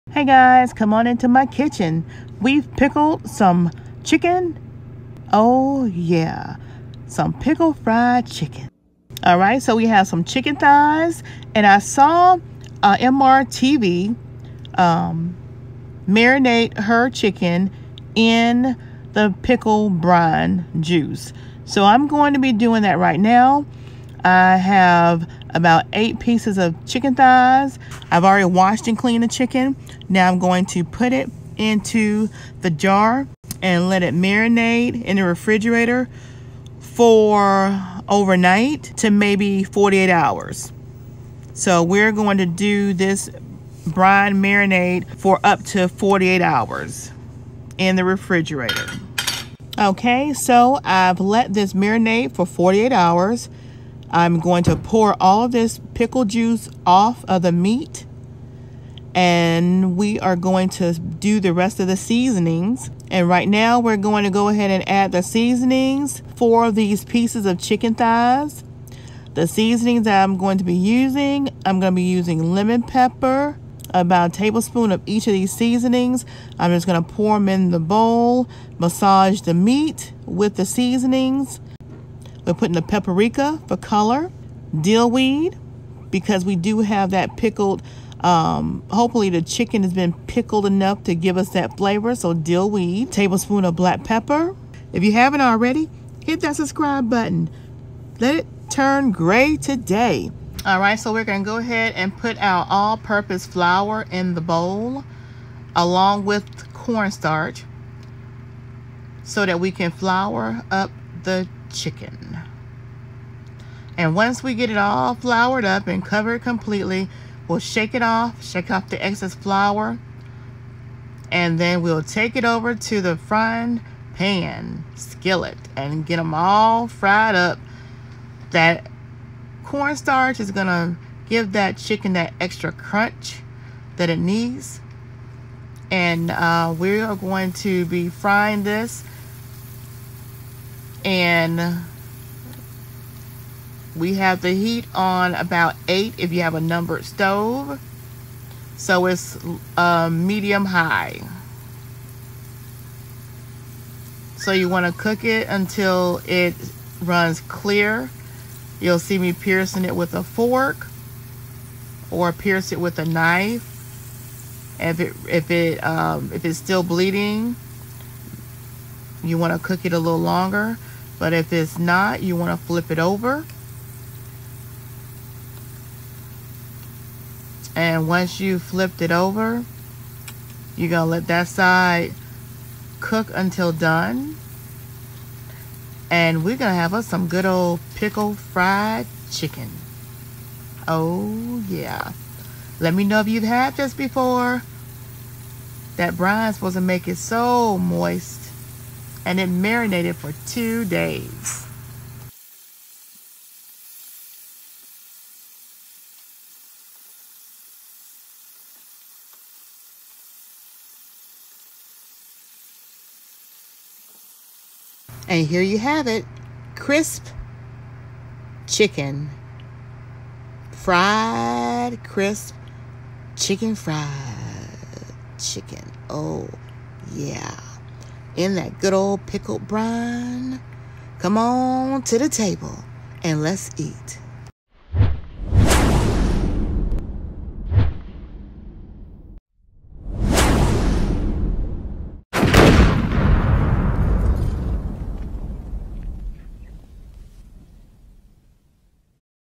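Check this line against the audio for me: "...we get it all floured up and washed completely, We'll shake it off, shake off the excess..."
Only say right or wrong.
wrong.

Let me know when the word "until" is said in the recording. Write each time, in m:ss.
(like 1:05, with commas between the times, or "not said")
2:35, 3:03.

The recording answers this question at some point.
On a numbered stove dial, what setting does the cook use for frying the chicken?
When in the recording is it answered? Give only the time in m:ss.
2:25.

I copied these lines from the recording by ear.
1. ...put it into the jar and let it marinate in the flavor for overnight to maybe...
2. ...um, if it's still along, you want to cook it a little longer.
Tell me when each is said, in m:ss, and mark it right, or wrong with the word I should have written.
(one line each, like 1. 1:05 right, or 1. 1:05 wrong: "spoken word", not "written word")
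1. 0:30 wrong: "refrigerator", not "flavor"
2. 2:45 wrong: "bleeding", not "along".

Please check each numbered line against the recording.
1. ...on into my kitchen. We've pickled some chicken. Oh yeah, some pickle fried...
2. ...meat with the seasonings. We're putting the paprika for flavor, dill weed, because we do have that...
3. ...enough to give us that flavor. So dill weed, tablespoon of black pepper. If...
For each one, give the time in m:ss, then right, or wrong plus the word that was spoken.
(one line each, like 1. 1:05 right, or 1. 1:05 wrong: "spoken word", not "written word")
1. 0:00 right
2. 1:19 wrong: "color", not "flavor"
3. 1:30 right.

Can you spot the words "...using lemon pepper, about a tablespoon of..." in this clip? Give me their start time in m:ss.
1:12.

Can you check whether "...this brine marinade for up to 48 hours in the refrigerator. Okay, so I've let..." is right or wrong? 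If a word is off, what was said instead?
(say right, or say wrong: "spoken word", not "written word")
right.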